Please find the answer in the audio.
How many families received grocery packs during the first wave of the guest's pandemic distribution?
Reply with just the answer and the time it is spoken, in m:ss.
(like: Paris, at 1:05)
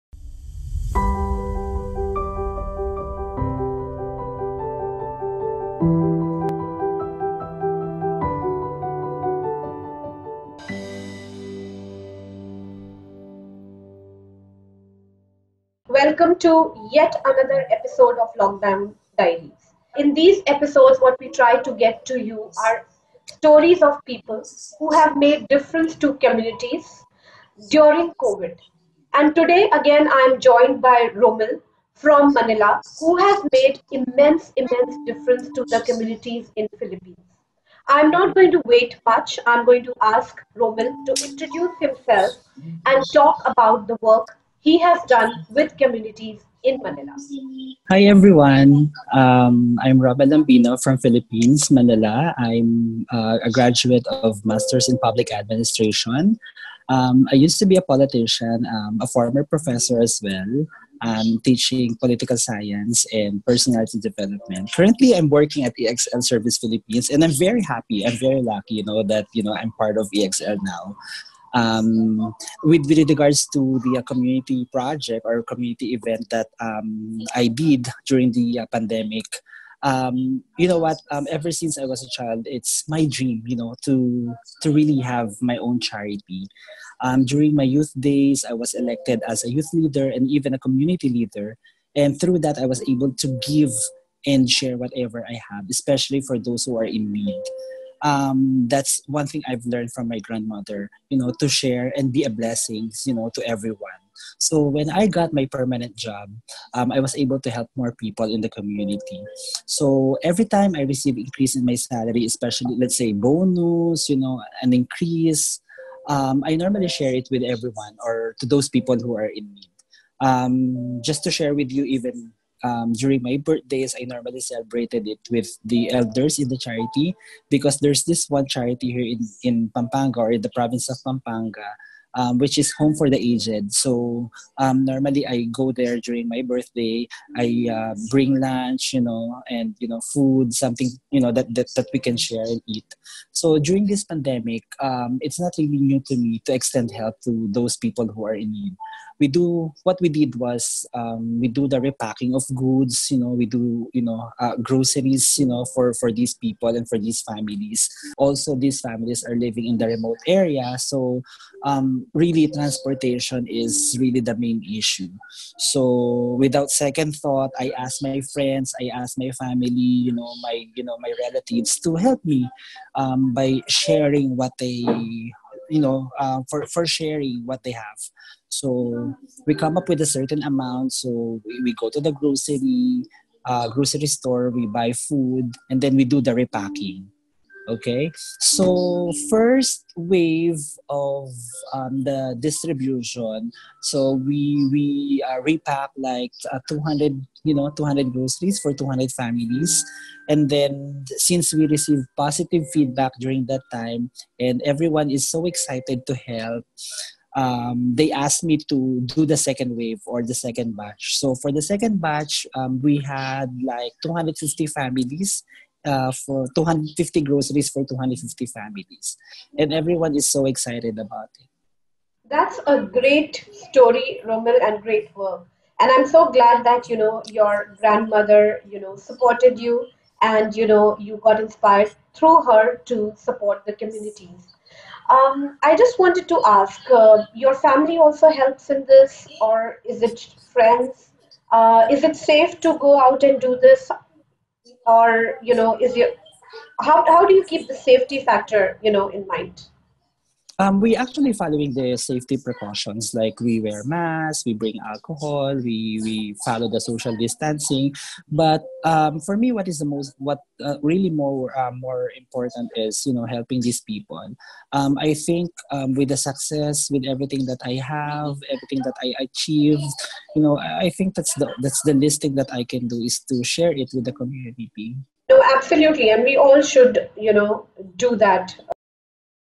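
200, at 3:17.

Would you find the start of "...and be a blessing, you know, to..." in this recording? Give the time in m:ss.
1:41.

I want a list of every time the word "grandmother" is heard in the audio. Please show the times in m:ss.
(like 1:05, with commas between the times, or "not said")
1:40, 3:47.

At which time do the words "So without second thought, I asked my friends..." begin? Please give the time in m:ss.
2:45.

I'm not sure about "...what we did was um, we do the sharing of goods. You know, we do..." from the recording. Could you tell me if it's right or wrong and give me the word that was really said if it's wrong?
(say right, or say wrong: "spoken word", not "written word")
wrong: "repacking", not "sharing".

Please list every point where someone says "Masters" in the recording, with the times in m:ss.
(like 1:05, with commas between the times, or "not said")
0:54.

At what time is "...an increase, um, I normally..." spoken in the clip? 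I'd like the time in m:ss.
1:54.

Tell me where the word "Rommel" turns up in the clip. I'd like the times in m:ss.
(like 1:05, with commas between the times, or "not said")
0:31, 0:40, 0:49, 3:44.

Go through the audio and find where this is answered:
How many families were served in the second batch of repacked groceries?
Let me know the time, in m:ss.
3:36.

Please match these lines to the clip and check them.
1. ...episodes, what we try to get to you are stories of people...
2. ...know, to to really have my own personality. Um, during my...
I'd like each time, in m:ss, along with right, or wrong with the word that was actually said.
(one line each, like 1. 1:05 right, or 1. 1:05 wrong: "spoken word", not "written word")
1. 0:20 right
2. 1:23 wrong: "charity", not "personality".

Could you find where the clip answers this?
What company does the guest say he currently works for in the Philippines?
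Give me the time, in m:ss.
1:05.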